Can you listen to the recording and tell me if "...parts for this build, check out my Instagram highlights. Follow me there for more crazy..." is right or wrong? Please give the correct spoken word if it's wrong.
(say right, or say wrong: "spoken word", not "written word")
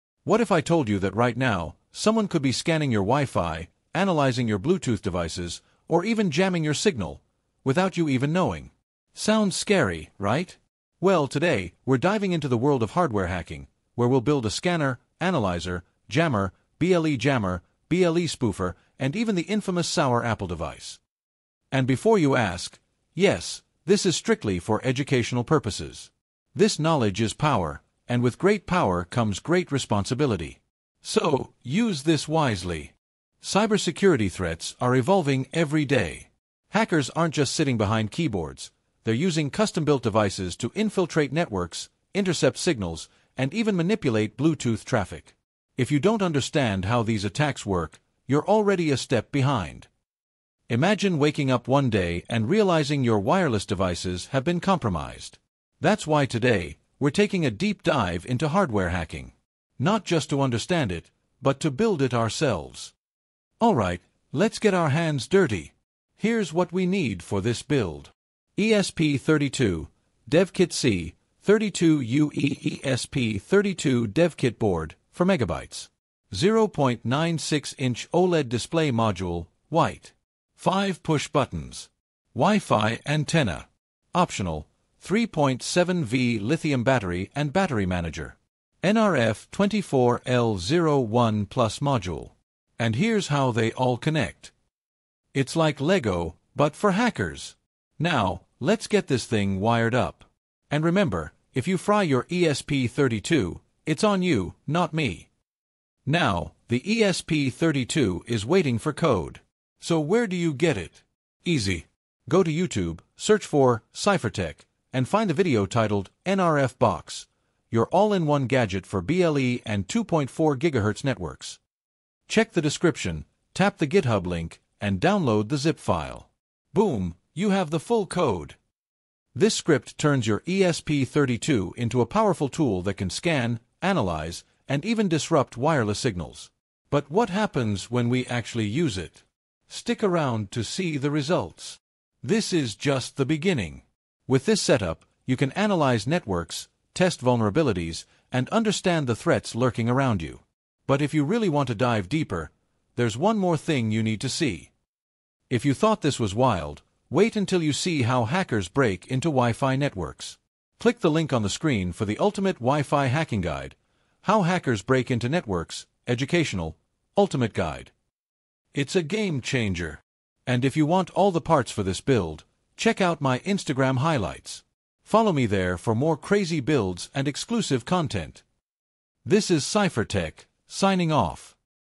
right.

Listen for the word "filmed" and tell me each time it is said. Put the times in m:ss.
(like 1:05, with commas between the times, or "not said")
not said.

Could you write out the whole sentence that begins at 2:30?
But if you really want to dive deeper, there's one more thing you need to see.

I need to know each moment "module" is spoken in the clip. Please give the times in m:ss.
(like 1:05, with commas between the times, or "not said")
1:18, 1:31.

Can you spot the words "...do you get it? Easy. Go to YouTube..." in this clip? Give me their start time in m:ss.
1:50.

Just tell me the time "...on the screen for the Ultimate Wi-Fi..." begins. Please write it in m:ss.
2:41.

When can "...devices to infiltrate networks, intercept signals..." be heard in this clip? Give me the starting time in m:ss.
0:40.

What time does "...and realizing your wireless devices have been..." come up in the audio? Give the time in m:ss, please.
0:52.